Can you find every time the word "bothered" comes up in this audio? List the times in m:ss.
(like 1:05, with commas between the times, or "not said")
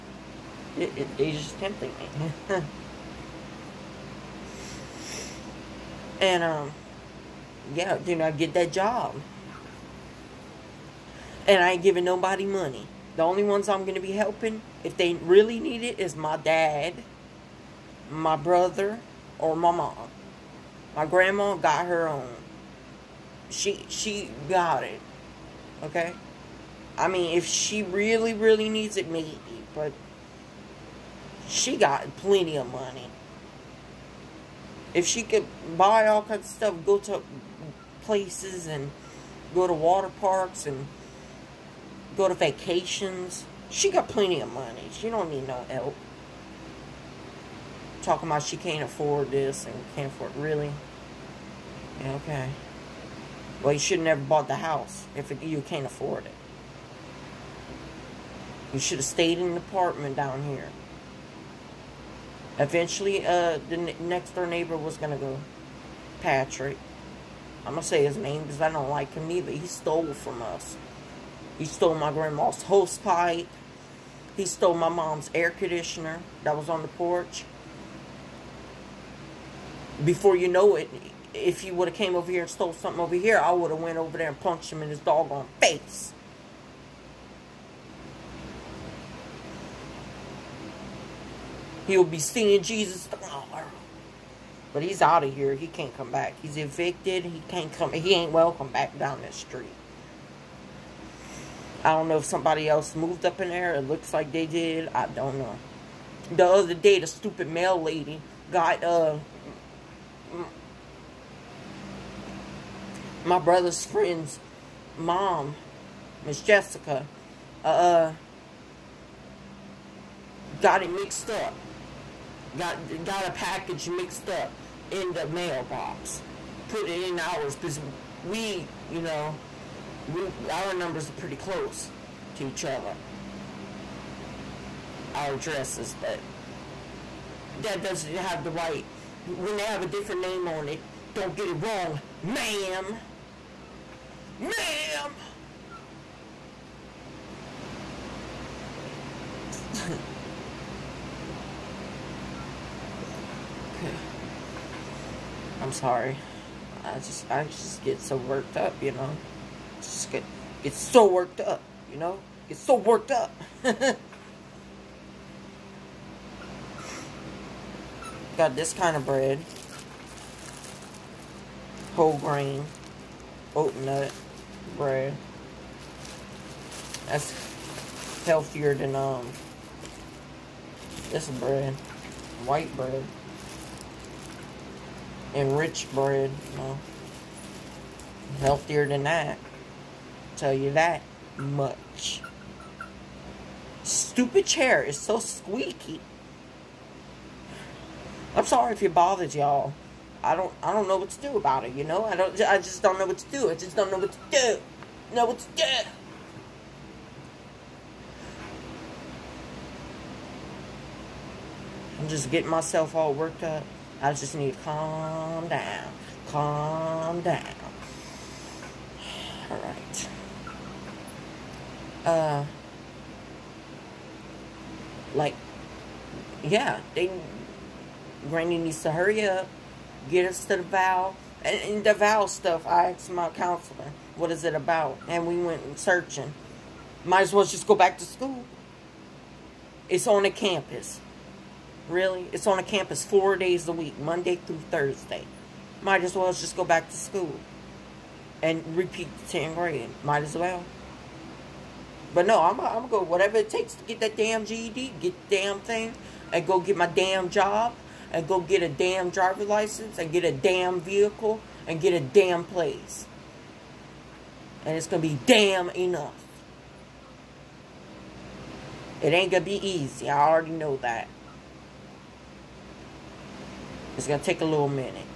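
3:18.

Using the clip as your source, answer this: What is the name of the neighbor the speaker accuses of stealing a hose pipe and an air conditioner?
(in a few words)
Patrick.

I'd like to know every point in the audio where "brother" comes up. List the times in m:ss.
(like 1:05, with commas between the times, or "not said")
0:18, 1:53.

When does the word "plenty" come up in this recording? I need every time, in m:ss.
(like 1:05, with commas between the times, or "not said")
0:32, 0:44.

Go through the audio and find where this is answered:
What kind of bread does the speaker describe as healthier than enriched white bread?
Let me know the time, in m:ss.
2:53.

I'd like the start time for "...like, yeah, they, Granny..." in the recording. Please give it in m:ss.
3:45.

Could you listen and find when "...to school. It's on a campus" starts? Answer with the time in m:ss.
3:57.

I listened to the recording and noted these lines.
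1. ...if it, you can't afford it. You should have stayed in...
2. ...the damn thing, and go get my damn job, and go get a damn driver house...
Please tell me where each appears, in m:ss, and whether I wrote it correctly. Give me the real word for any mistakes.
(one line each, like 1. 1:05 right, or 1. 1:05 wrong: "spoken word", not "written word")
1. 0:55 right
2. 4:15 wrong: "license", not "house".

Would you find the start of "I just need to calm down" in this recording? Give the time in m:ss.
3:34.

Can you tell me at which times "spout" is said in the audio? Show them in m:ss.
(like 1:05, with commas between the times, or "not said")
not said.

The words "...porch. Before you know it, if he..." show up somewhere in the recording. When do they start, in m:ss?
1:16.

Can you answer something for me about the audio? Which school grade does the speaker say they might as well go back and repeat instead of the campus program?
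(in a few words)
10th grade.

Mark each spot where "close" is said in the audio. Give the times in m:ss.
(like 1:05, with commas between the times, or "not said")
2:11.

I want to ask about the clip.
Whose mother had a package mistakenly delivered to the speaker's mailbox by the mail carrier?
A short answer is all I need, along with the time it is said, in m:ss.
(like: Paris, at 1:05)
Miss Jessica, at 1:56.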